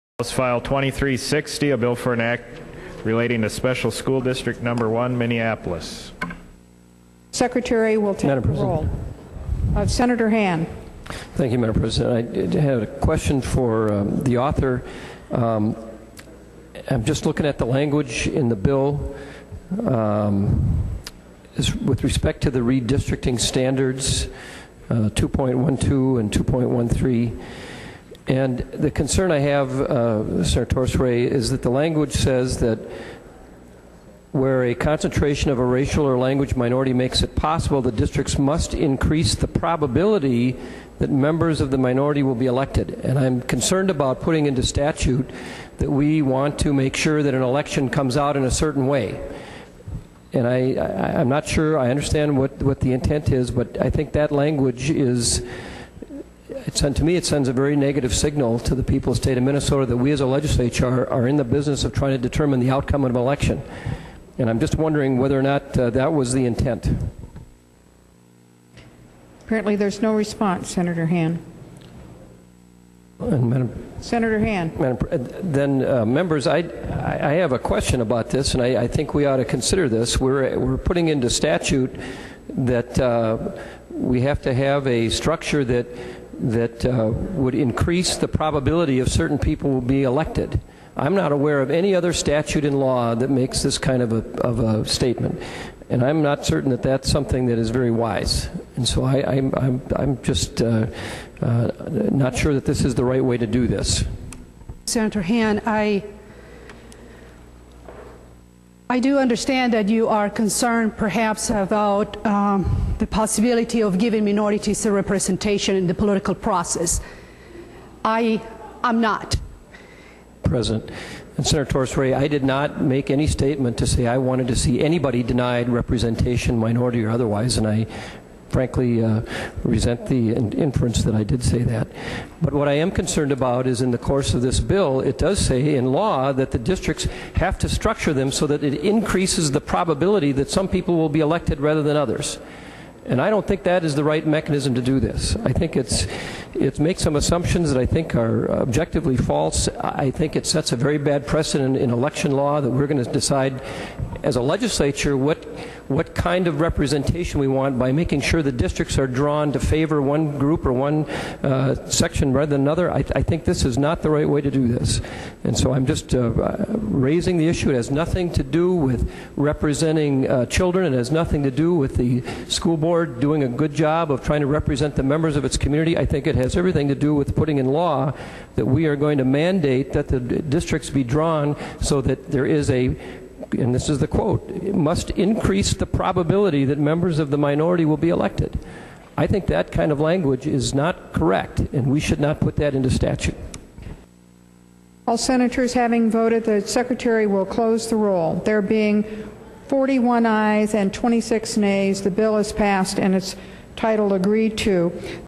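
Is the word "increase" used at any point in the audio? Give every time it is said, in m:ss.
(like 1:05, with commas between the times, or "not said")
0:38, 1:27, 2:18, 3:05.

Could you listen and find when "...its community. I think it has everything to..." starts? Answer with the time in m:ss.
2:55.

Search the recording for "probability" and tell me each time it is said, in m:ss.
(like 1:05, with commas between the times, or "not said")
0:39, 1:28, 2:19, 3:05.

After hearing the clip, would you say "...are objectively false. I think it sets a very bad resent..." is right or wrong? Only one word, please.
wrong.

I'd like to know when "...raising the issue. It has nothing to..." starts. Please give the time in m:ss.
2:46.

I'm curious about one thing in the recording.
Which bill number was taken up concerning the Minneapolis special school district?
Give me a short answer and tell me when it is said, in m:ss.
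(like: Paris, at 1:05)
House File 2360, at 0:00.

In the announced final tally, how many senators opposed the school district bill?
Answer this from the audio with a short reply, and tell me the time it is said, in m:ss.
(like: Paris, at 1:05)
26, at 3:20.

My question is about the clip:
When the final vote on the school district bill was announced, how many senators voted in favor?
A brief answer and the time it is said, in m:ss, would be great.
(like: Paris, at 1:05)
41, at 3:19.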